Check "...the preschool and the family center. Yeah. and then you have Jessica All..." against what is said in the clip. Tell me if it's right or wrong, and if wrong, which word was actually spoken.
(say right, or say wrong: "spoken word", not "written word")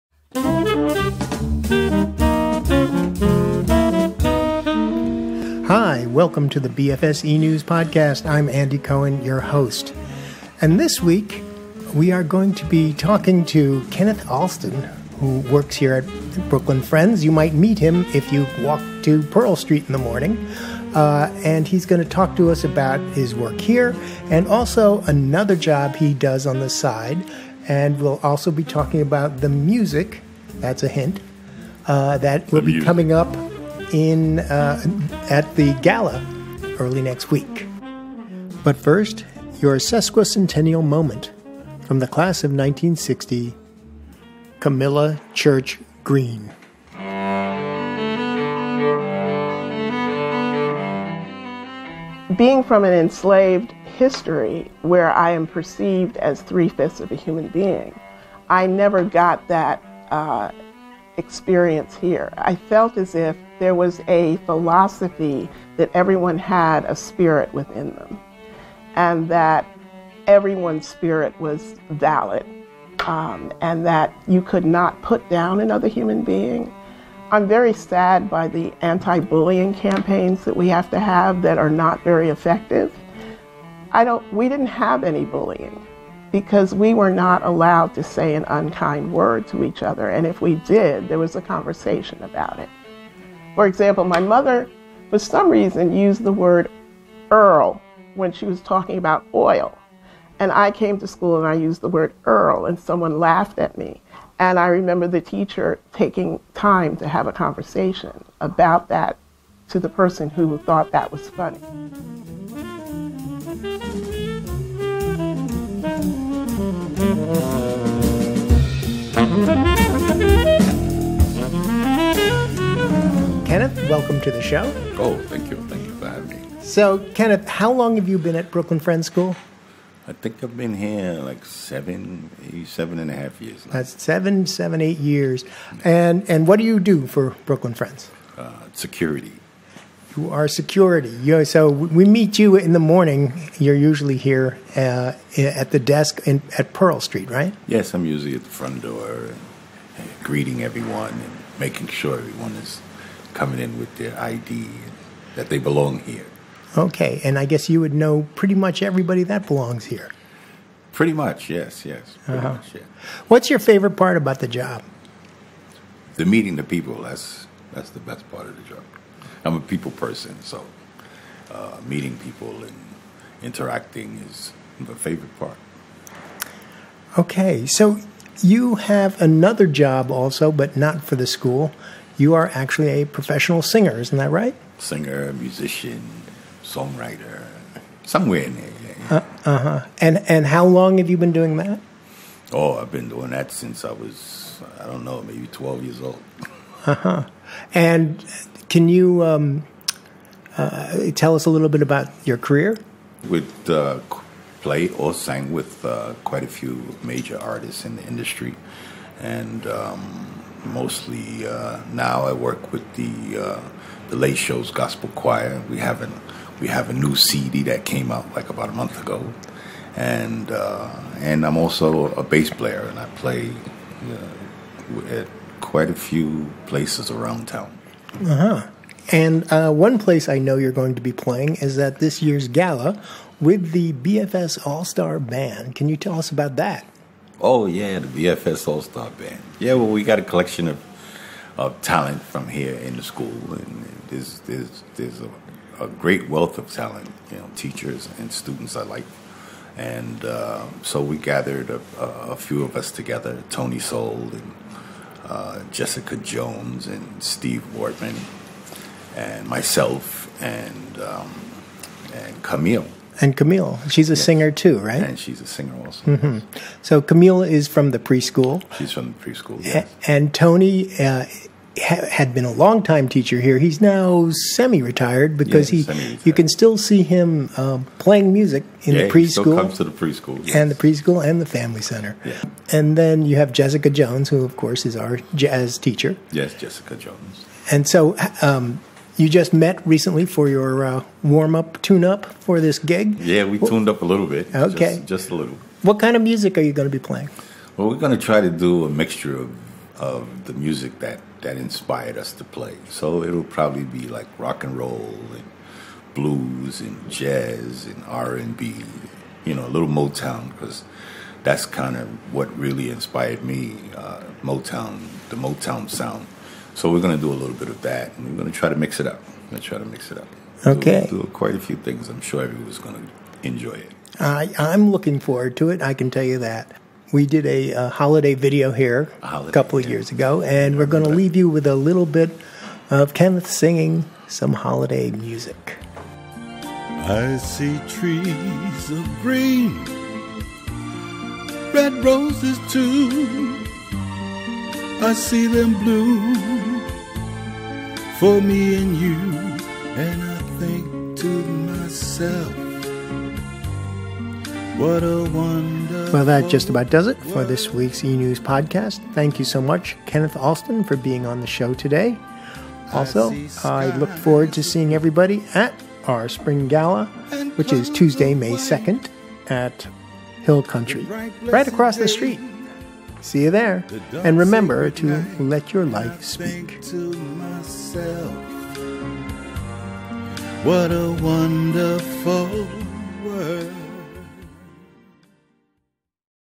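wrong: "Jones", not "All".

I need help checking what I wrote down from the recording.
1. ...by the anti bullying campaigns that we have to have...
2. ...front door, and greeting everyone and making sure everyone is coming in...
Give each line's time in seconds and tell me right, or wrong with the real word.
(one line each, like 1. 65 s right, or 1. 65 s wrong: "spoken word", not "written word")
1. 78 s right
2. 148 s right.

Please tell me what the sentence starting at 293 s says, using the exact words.
Yeah, we tuned up a little bit.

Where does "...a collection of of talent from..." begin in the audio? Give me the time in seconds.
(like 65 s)
240 s.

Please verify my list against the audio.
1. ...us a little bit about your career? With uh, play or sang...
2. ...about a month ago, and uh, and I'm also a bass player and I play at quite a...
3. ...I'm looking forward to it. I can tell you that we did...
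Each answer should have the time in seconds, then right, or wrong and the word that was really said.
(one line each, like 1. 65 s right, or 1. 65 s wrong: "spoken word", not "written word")
1. 201 s right
2. 218 s right
3. 324 s right.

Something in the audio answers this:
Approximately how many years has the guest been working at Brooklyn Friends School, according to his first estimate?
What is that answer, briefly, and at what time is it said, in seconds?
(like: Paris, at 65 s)
7 and a half years, at 132 s.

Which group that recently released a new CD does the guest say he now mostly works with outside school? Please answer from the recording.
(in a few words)
The Late Show's Gospel Choir.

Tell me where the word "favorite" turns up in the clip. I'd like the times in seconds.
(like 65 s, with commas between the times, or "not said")
163 s, 174 s.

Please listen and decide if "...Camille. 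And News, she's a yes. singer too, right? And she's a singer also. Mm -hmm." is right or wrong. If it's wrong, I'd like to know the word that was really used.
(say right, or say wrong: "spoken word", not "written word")
wrong: "Camille", not "News".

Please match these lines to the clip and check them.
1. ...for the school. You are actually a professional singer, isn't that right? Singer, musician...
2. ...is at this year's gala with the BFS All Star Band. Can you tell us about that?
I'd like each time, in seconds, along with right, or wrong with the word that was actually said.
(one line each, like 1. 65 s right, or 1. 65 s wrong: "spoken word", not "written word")
1. 181 s right
2. 231 s right.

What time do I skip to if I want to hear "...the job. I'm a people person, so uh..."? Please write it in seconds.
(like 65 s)
168 s.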